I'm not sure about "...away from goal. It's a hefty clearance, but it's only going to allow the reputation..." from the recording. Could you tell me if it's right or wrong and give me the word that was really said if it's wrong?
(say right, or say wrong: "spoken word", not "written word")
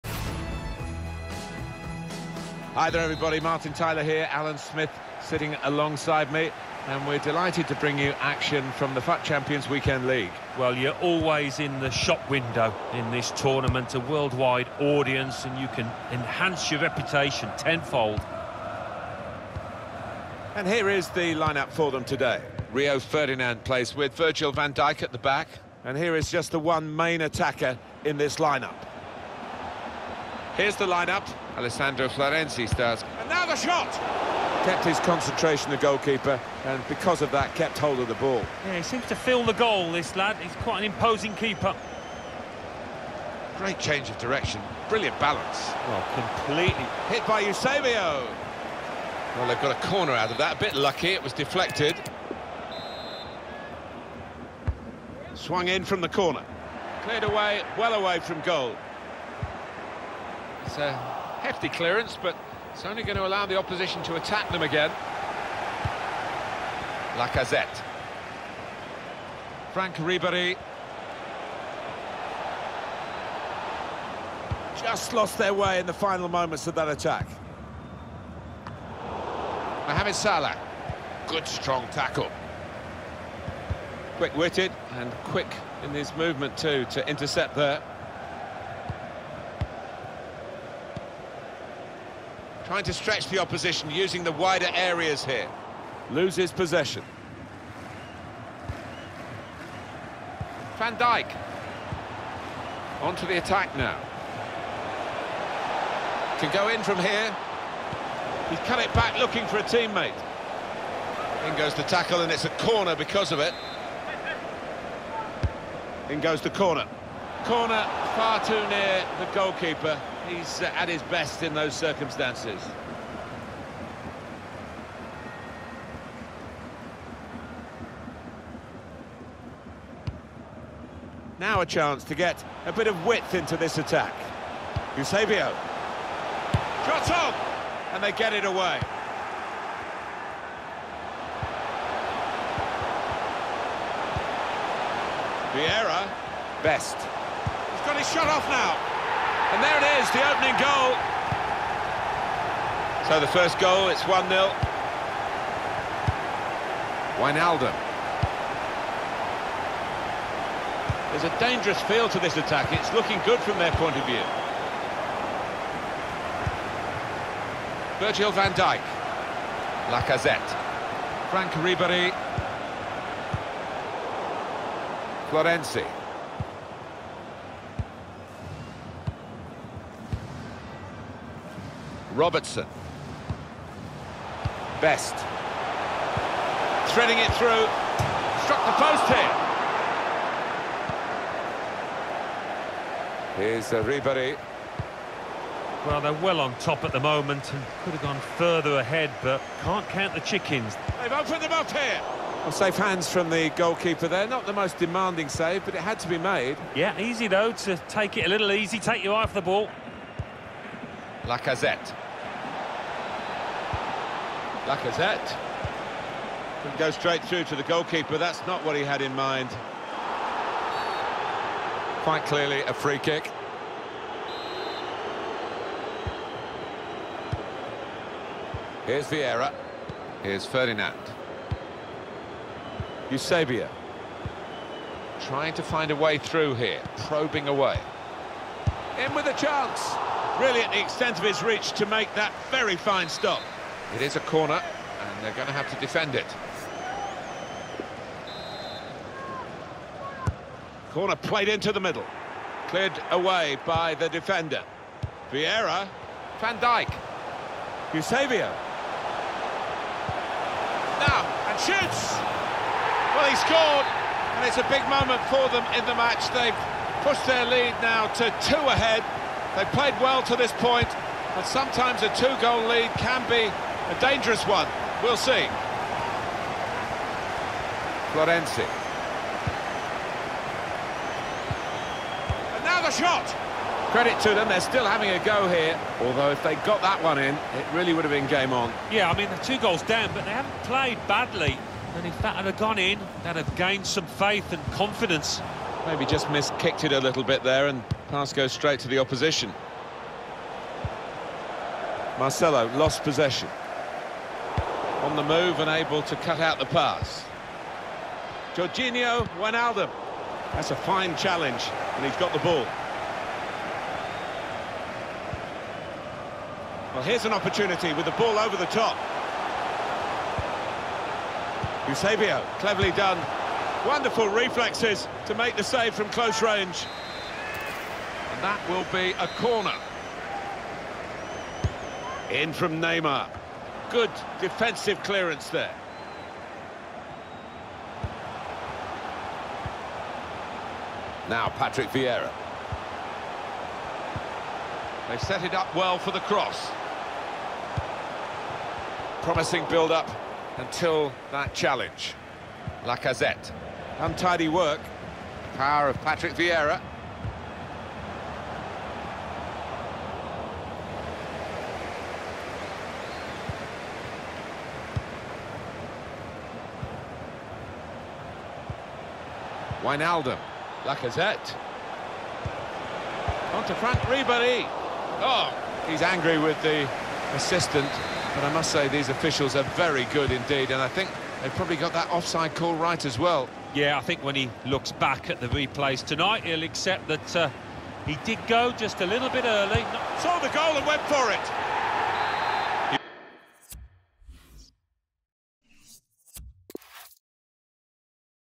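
wrong: "opposition", not "reputation".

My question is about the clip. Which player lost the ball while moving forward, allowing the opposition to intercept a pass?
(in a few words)
Marcelo.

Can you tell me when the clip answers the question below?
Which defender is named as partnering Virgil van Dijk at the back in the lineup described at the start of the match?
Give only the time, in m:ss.
0:22.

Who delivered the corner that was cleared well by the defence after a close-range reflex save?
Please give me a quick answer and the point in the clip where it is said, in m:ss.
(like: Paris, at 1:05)
Neymar, at 5:32.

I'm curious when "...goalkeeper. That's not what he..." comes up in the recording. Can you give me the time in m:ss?
3:37.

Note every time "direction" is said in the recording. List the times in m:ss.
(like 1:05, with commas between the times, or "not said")
0:44.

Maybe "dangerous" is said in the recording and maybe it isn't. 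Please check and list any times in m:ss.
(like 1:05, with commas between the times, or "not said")
2:41, 4:33.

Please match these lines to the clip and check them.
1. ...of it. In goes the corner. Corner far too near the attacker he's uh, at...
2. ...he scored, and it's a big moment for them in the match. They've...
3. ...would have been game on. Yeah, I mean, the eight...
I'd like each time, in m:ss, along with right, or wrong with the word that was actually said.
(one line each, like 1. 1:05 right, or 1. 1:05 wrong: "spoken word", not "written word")
1. 1:53 wrong: "goalkeeper", not "attacker"
2. 4:23 right
3. 4:47 wrong: "two", not "eight".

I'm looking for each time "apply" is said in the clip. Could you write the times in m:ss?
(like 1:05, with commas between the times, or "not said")
not said.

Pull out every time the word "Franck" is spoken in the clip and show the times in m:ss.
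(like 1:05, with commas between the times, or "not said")
1:09, 2:51, 6:13.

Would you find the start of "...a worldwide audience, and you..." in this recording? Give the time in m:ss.
0:13.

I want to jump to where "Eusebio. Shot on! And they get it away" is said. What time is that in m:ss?
2:14.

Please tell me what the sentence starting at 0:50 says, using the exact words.
A bit lucky, it was deflected.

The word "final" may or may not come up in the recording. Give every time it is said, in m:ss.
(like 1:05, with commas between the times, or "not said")
1:15.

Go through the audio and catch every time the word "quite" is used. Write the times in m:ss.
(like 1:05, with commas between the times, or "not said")
0:40, 3:42.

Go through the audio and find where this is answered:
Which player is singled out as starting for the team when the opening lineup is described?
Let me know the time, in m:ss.
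0:31.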